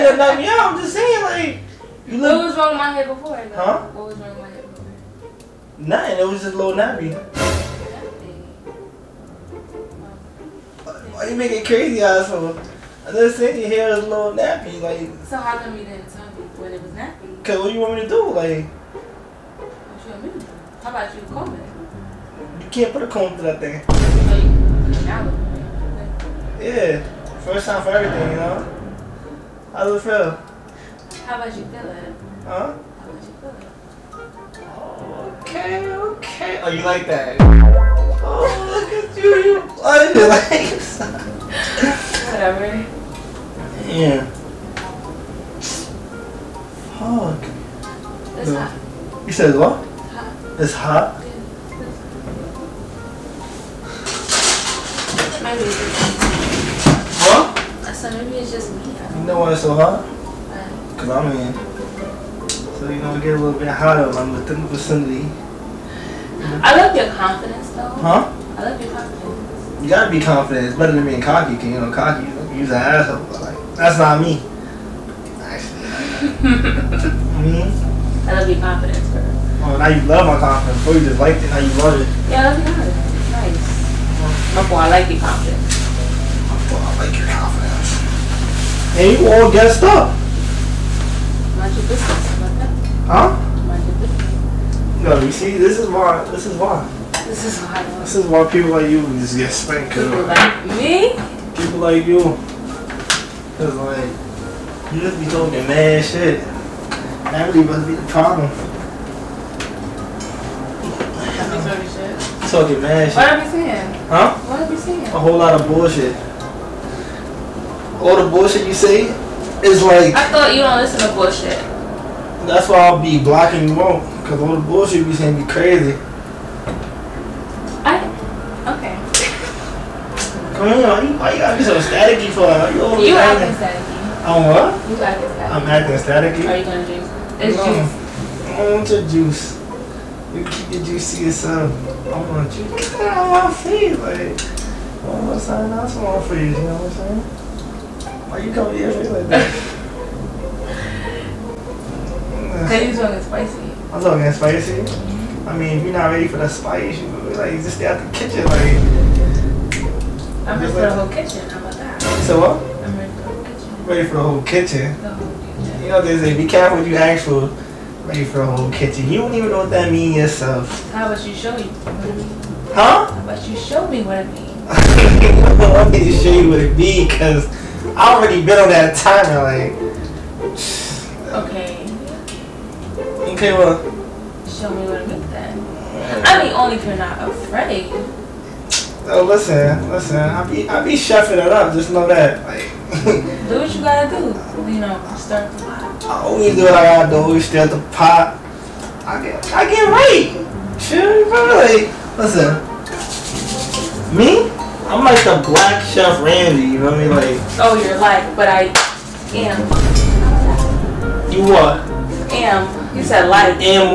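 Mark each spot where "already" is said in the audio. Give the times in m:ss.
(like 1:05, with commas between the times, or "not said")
2:58.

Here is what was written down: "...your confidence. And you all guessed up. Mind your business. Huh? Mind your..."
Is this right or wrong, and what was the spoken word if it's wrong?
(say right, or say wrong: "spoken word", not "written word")
right.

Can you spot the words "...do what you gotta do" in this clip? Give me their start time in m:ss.
3:13.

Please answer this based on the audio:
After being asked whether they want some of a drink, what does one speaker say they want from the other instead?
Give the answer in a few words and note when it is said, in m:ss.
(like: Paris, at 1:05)
your juice, at 2:18.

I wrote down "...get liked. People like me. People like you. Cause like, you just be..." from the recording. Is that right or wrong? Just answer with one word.
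wrong.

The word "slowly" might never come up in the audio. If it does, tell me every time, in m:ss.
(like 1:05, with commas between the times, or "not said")
not said.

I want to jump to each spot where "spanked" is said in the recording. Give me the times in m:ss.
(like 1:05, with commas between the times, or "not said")
1:39.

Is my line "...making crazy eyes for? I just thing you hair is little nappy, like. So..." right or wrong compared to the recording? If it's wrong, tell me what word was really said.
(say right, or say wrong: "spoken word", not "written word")
right.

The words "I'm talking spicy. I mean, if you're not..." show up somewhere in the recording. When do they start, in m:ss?
2:33.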